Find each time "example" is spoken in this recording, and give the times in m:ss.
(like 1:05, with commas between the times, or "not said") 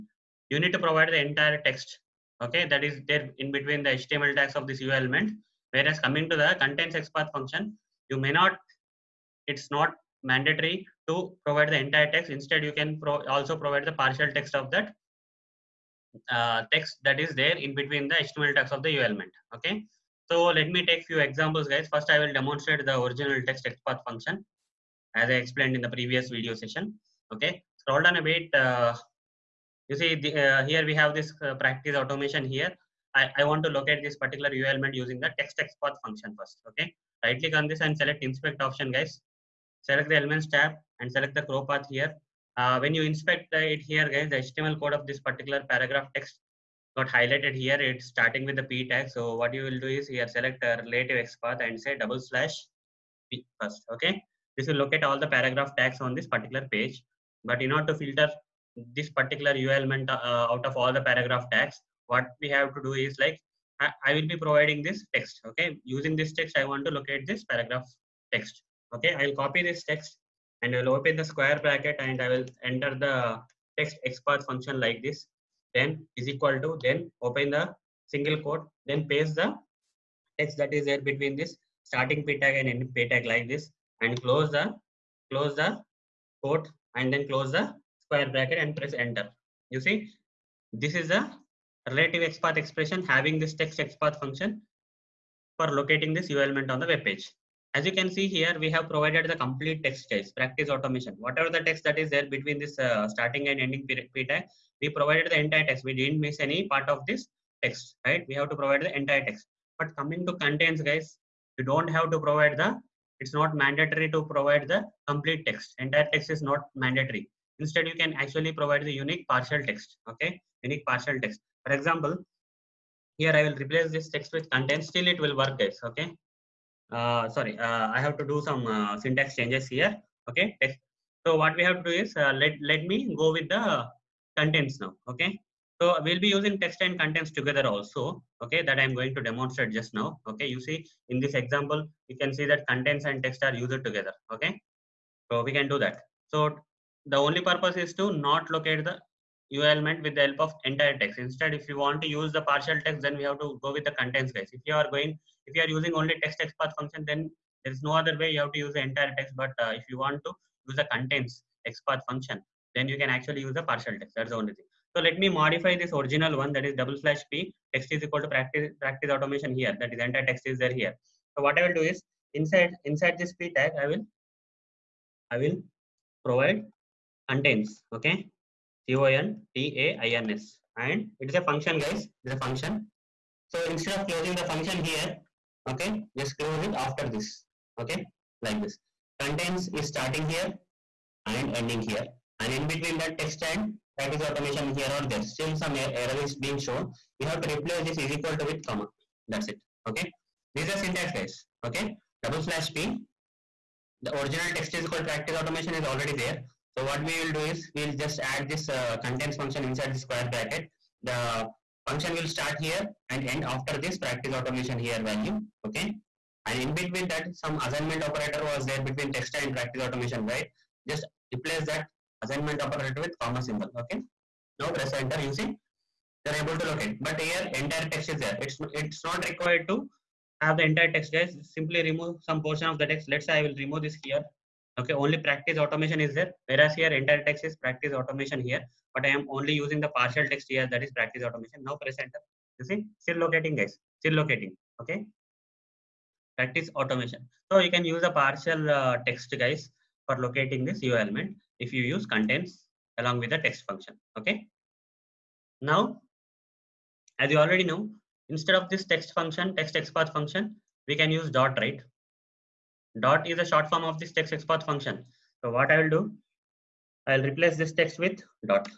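0:21, 2:01, 2:21.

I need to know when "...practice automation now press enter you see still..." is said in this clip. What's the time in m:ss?
4:00.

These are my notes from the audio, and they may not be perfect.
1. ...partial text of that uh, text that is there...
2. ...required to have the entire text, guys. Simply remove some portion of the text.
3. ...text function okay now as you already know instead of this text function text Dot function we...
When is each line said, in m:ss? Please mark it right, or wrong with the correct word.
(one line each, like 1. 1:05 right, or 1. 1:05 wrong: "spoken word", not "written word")
1. 0:13 right
2. 3:49 right
3. 4:13 wrong: "XPath", not "Dot".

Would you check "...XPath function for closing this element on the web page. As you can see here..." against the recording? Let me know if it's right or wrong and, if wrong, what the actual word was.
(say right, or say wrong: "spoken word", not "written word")
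wrong: "locating", not "closing".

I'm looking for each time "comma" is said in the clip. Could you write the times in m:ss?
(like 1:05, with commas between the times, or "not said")
3:18, 3:43.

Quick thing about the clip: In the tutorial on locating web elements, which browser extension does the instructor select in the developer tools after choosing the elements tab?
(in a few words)
ChroPath.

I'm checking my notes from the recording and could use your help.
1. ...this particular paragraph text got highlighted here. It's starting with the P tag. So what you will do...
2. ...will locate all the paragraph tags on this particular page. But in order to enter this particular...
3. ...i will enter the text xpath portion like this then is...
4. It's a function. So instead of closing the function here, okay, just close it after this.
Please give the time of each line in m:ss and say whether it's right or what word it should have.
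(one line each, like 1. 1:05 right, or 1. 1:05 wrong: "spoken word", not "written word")
1. 0:45 right
2. 0:54 wrong: "filter", not "enter"
3. 1:12 wrong: "function", not "portion"
4. 3:02 right.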